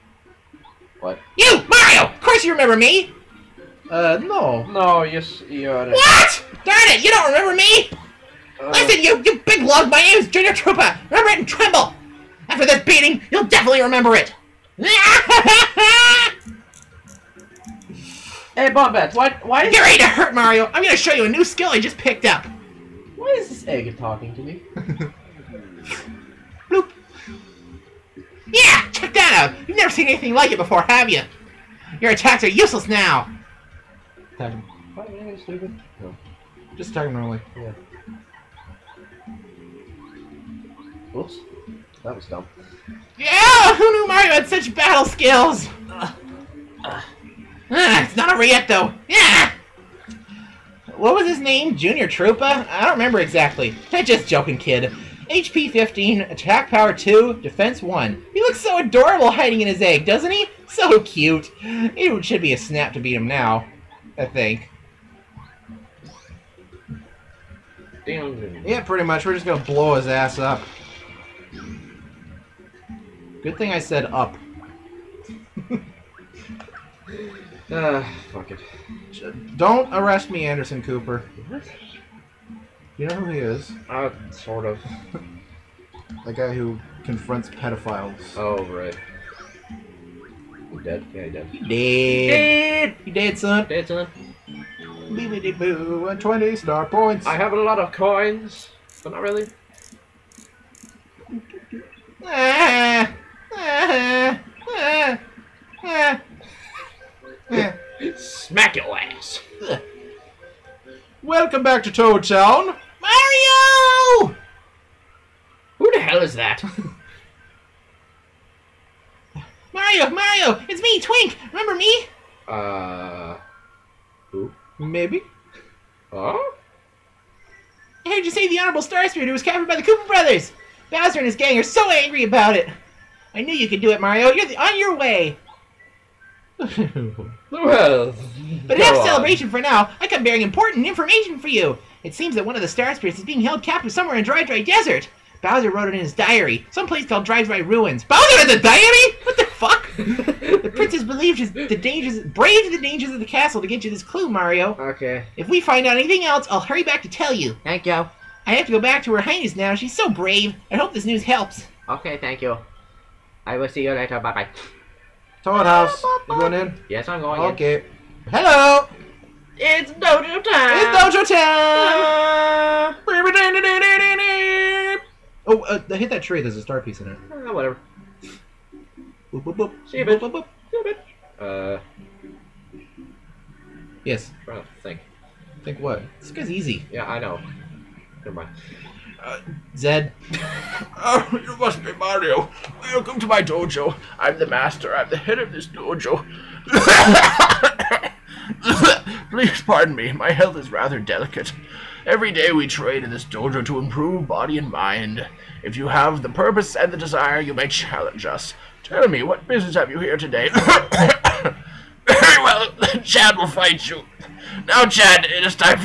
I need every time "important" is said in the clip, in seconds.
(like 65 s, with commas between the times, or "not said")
140 s.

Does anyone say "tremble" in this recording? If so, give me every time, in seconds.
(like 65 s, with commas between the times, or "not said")
11 s.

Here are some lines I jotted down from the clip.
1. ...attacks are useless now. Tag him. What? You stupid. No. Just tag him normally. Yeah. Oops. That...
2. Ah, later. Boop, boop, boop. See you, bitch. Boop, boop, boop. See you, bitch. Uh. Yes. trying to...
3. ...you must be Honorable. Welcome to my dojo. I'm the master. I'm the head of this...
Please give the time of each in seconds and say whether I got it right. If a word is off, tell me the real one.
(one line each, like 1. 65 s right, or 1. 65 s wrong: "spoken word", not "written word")
1. 32 s right
2. 177 s wrong: "whatever", not "later"
3. 191 s wrong: "Mario", not "Honorable".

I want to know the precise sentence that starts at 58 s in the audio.
He looks so adorable hiding in his egg, doesn't he?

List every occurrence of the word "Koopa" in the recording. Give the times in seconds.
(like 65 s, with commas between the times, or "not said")
129 s.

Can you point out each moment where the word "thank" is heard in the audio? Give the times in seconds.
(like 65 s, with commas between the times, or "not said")
157 s, 162 s.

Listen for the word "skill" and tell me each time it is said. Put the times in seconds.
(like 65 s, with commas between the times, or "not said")
21 s, 45 s.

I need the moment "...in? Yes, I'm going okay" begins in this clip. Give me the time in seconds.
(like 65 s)
166 s.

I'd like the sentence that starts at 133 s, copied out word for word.
I knew you could do it, Mario.